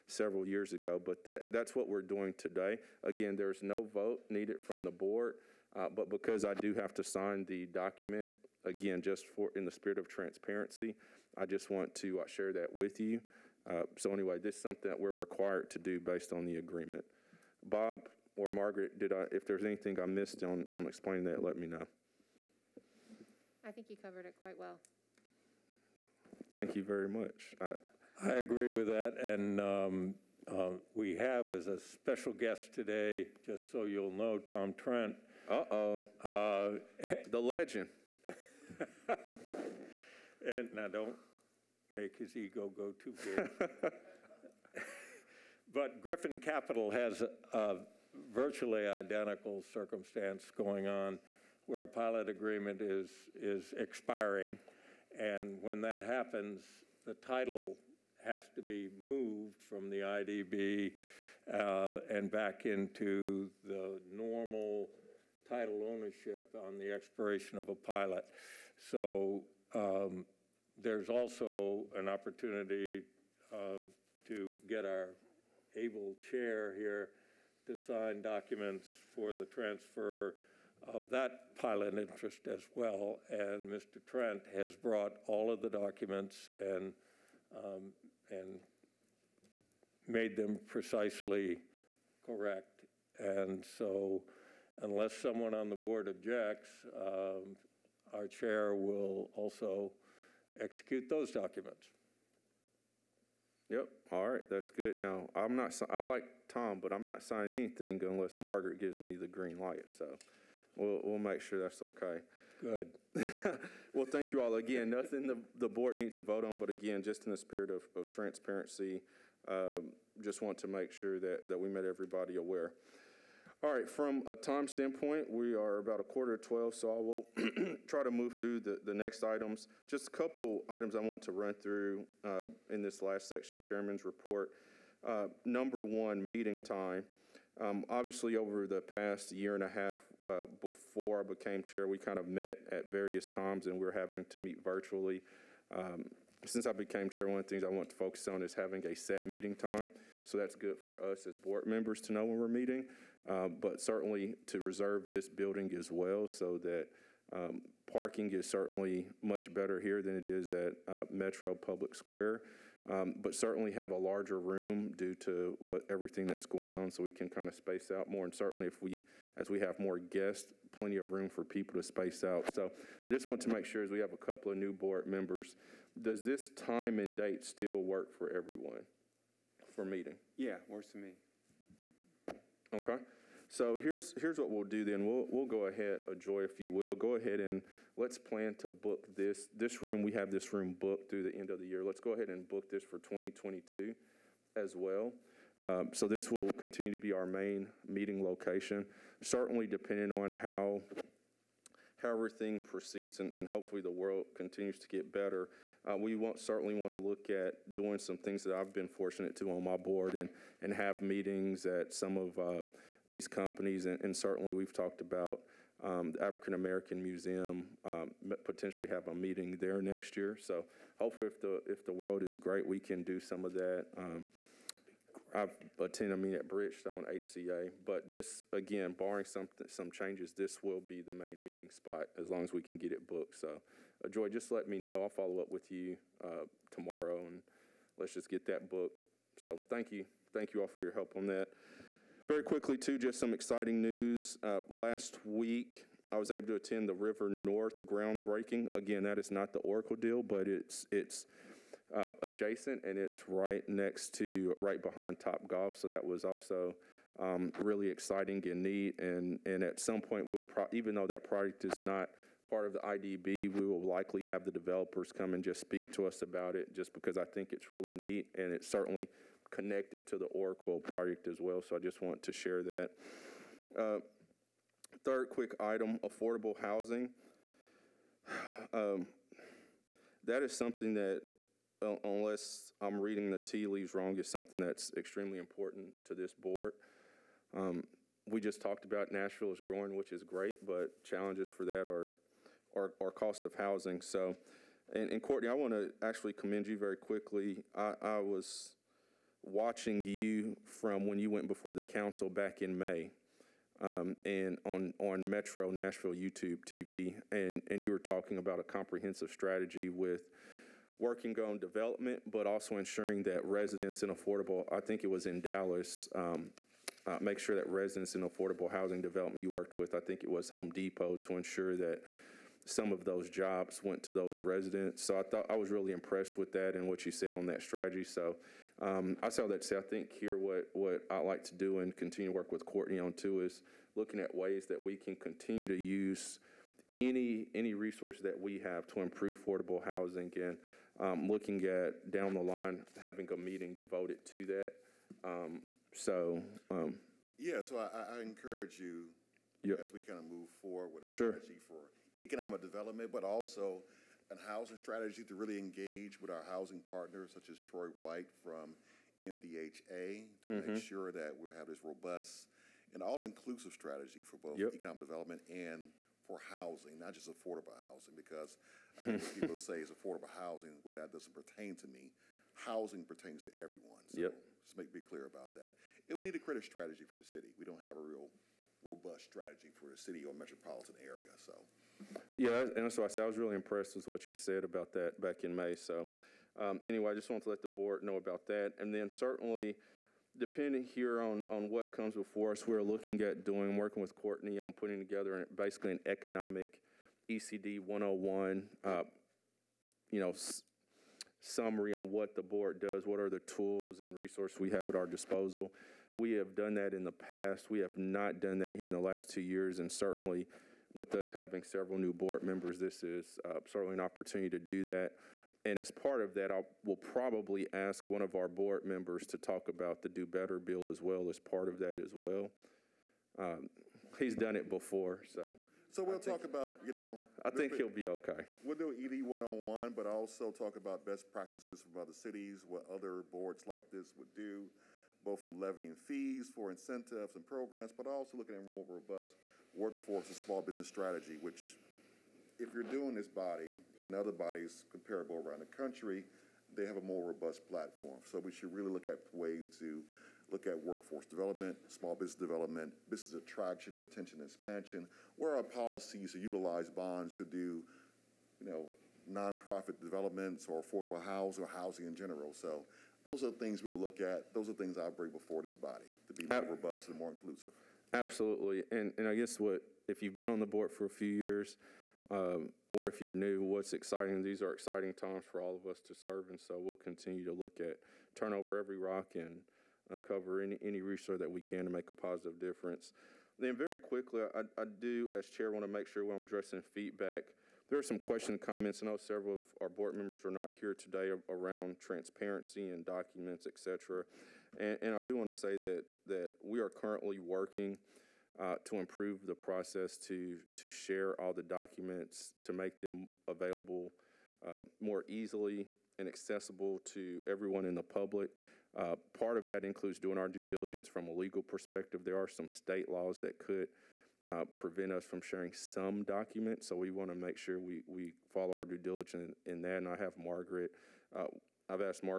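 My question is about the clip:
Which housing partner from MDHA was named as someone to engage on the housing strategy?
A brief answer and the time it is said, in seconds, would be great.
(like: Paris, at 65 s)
Troy White, at 357 s.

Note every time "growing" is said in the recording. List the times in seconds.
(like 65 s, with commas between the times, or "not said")
289 s.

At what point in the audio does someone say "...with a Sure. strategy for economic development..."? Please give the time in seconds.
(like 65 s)
350 s.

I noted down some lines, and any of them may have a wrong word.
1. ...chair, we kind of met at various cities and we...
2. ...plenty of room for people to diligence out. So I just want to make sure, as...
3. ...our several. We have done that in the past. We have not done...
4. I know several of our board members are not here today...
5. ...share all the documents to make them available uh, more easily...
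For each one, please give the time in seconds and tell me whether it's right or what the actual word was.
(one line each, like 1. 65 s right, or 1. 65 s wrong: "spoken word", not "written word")
1. 141 s wrong: "times", not "cities"
2. 170 s wrong: "space", not "diligence"
3. 404 s wrong: "disposal", not "several"
4. 489 s right
5. 500 s right.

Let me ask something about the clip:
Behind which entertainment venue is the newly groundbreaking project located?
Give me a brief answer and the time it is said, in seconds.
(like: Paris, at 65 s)
Top Golf, at 255 s.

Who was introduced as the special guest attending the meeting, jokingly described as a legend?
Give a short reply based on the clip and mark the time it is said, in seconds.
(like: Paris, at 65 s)
Tom Trent, at 34 s.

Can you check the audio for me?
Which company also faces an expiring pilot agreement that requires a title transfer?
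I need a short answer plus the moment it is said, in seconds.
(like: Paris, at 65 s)
Griffin Capital, at 46 s.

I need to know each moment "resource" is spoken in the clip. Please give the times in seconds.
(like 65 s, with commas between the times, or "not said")
337 s, 404 s, 481 s.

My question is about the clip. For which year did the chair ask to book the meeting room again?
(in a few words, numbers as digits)
2022.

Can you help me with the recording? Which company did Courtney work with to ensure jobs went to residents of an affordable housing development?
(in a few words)
Home Depot.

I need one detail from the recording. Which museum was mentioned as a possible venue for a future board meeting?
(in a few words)
African American Museum.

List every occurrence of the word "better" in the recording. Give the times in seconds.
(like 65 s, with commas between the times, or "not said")
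159 s, 205 s, 420 s.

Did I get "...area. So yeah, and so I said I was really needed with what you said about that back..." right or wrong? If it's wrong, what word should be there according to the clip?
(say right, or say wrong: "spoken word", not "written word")
wrong: "impressed", not "needed".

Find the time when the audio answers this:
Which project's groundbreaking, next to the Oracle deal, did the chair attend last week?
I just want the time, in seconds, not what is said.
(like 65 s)
246 s.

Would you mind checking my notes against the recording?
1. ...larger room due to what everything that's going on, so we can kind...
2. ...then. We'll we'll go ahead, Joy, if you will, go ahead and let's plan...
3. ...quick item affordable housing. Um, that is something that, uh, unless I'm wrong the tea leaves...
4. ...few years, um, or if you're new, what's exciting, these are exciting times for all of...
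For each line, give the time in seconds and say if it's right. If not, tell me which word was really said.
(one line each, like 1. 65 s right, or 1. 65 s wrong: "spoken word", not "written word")
1. 163 s right
2. 184 s right
3. 275 s wrong: "reading", not "wrong"
4. 471 s right.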